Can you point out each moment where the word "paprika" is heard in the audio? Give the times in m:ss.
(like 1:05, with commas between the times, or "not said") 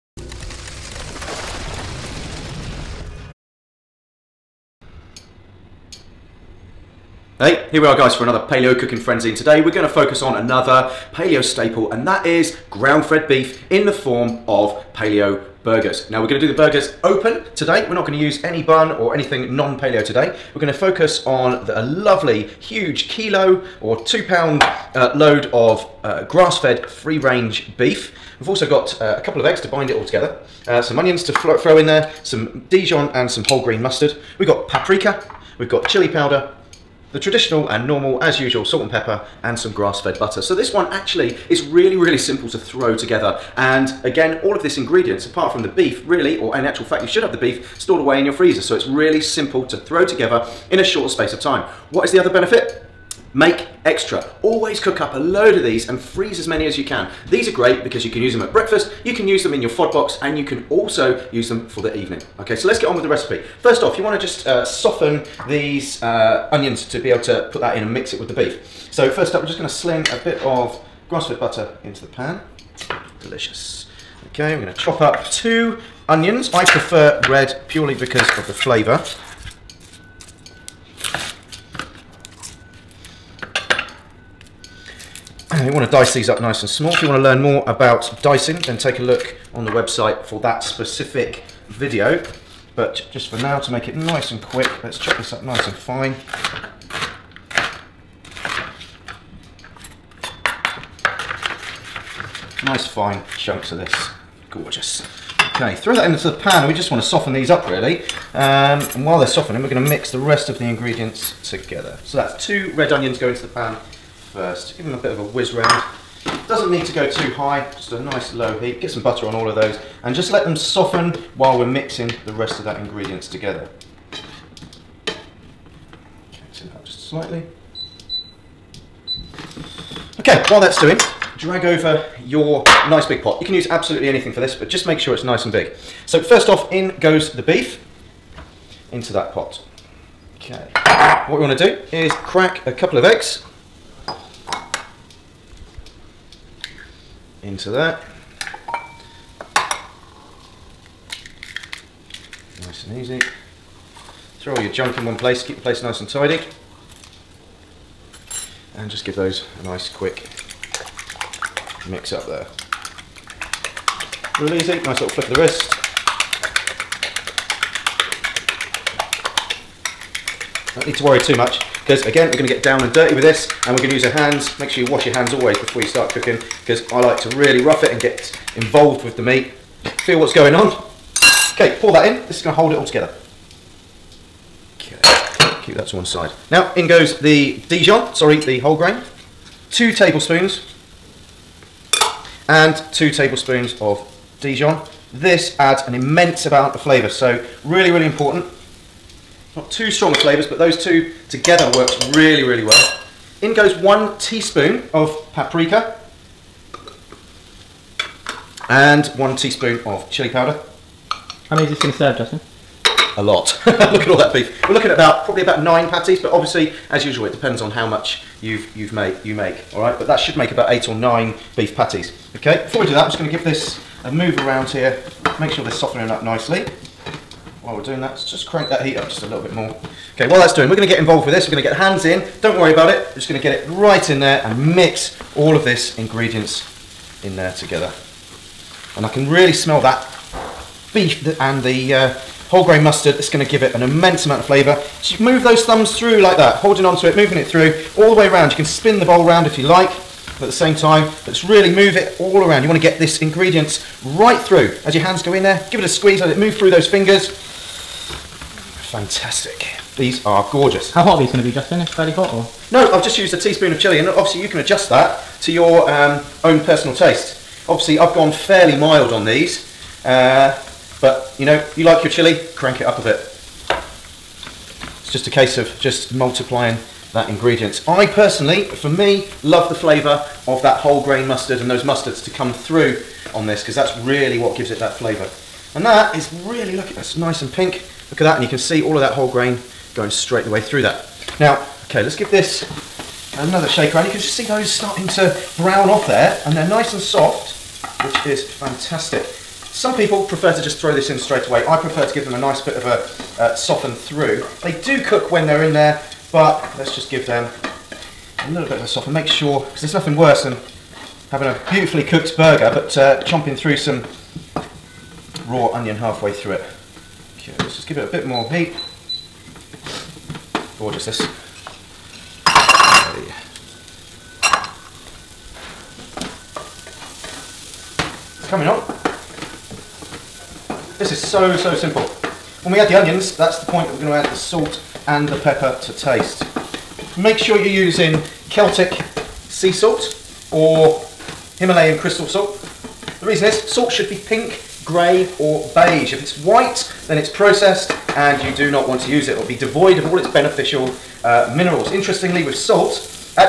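0:34, 3:25.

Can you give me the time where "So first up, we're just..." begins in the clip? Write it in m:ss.
1:08.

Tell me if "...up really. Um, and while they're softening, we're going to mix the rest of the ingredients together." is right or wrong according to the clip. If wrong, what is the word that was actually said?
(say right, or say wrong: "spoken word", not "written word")
right.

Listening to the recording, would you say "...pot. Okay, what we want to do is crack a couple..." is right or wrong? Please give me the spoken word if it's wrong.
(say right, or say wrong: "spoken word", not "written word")
right.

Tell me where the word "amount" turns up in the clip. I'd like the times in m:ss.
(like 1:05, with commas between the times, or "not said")
3:16, 4:04.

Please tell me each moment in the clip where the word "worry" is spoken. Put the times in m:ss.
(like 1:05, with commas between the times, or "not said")
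2:51, 3:52.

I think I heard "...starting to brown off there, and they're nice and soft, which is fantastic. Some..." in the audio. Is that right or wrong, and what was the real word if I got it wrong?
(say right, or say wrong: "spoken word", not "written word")
right.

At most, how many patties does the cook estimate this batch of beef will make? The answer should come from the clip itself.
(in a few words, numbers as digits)
9.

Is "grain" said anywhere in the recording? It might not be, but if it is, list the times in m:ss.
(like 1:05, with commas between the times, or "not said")
0:33, 3:08, 4:02, 4:41, 4:49.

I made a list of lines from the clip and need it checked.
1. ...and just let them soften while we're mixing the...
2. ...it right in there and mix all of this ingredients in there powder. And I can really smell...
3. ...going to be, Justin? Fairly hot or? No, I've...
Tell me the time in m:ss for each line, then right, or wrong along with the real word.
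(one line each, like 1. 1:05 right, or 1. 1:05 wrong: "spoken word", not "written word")
1. 2:00 right
2. 3:53 wrong: "together", not "powder"
3. 4:21 right.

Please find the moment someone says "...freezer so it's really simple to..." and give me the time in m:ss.
0:48.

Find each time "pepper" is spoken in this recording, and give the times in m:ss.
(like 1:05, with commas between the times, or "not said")
0:38, 5:35.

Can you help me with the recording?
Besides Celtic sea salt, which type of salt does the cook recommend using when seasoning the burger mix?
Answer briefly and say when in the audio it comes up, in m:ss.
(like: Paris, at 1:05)
Himalayan crystal salt, at 5:41.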